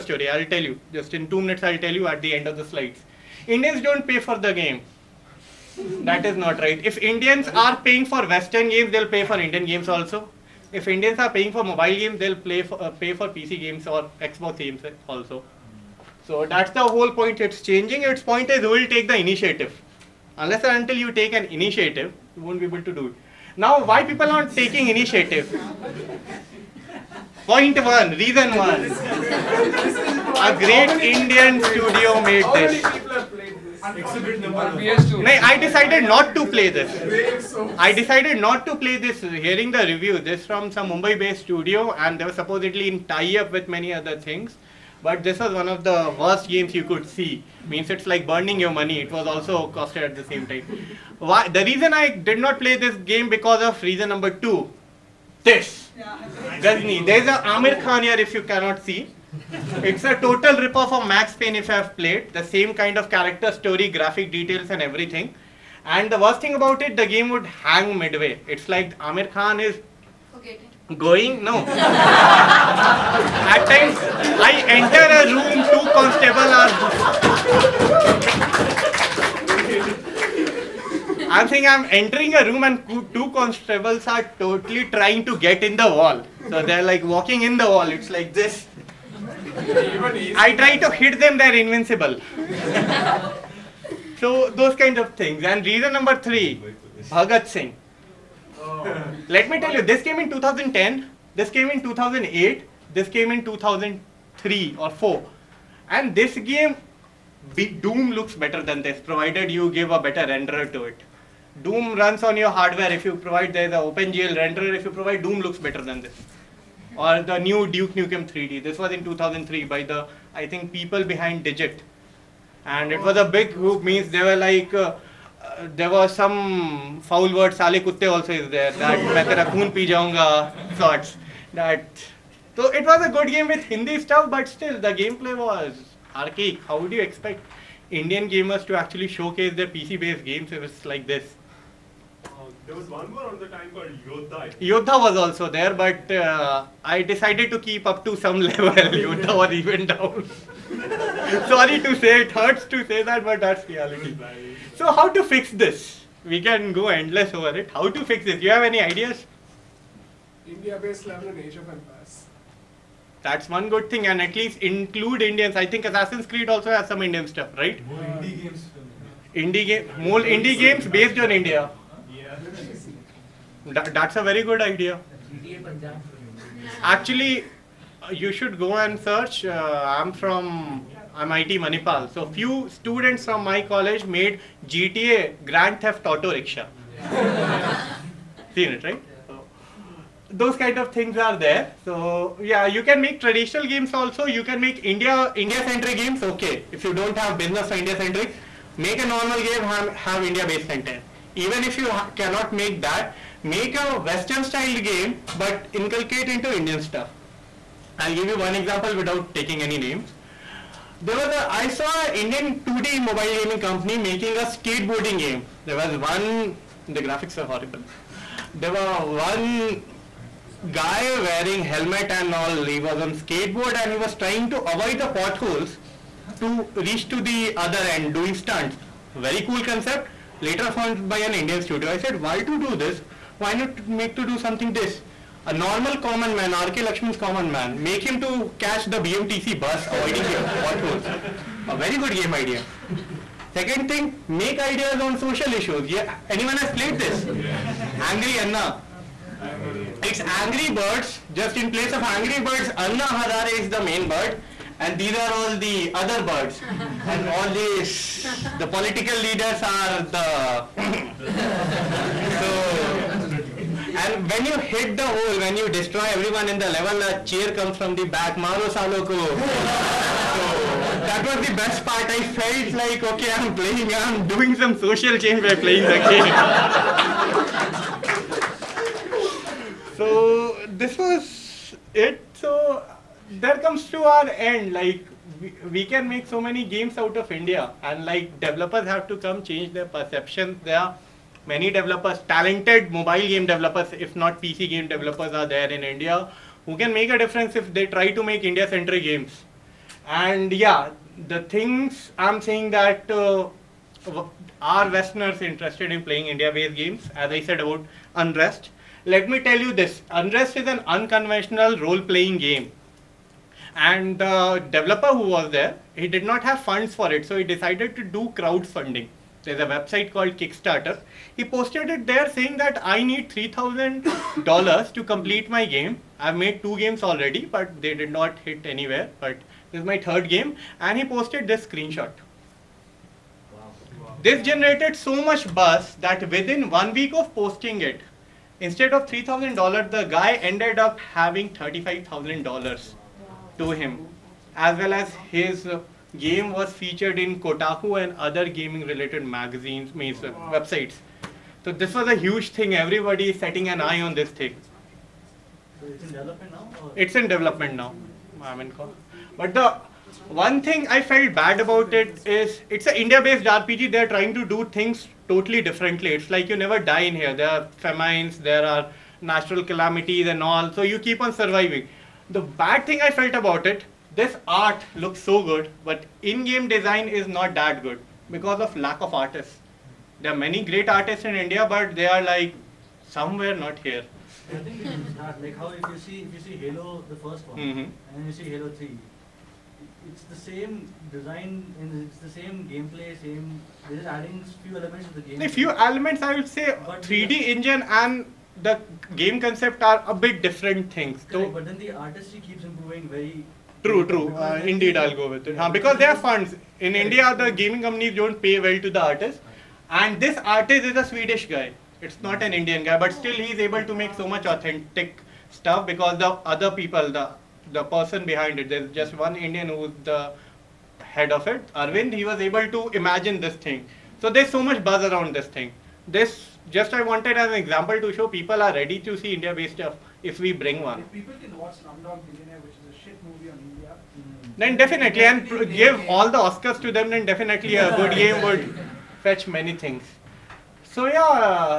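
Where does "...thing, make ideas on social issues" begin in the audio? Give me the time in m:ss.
4:03.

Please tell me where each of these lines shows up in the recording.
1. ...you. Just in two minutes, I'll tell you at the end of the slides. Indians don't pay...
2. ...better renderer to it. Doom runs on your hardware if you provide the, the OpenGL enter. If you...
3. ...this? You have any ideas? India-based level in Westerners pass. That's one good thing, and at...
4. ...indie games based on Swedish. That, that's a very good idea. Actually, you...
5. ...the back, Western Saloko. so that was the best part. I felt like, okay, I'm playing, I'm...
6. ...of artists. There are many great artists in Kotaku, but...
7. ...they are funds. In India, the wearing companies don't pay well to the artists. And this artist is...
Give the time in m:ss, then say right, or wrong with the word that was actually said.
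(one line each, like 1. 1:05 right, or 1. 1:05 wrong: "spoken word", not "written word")
1. 0:00 right
2. 1:49 wrong: "renderer", not "enter"
3. 2:38 wrong: "Asia", not "Westerners"
4. 2:50 wrong: "India", not "Swedish"
5. 4:27 wrong: "Maro", not "Western"
6. 6:19 wrong: "India", not "Kotaku"
7. 6:45 wrong: "gaming", not "wearing".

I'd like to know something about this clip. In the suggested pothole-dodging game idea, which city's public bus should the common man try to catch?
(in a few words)
BMTC.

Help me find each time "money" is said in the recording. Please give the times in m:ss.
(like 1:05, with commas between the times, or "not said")
0:48.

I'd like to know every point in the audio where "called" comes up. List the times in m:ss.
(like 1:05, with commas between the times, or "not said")
2:23, 5:20.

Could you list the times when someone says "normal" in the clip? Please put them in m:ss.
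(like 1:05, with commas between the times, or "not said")
3:19, 3:55.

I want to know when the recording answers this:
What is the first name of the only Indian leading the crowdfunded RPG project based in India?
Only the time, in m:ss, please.
7:01.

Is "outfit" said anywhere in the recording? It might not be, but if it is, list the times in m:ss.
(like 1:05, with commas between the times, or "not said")
not said.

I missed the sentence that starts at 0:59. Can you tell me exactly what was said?
It's a total rip-off of Max Payne if I've played.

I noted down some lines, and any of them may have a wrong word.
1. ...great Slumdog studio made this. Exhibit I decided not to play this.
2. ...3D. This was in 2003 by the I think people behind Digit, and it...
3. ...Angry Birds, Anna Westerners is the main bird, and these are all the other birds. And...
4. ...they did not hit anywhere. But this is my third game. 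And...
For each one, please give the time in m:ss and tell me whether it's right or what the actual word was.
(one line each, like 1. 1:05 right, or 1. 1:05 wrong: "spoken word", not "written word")
1. 0:30 wrong: "Indian", not "Slumdog"
2. 1:58 right
3. 4:12 wrong: "Hazare", not "Westerners"
4. 5:27 right.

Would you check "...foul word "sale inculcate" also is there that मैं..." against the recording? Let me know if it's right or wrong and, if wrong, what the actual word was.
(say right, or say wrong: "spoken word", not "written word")
wrong: "kutte", not "inculcate".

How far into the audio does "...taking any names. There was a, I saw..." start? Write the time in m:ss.
3:29.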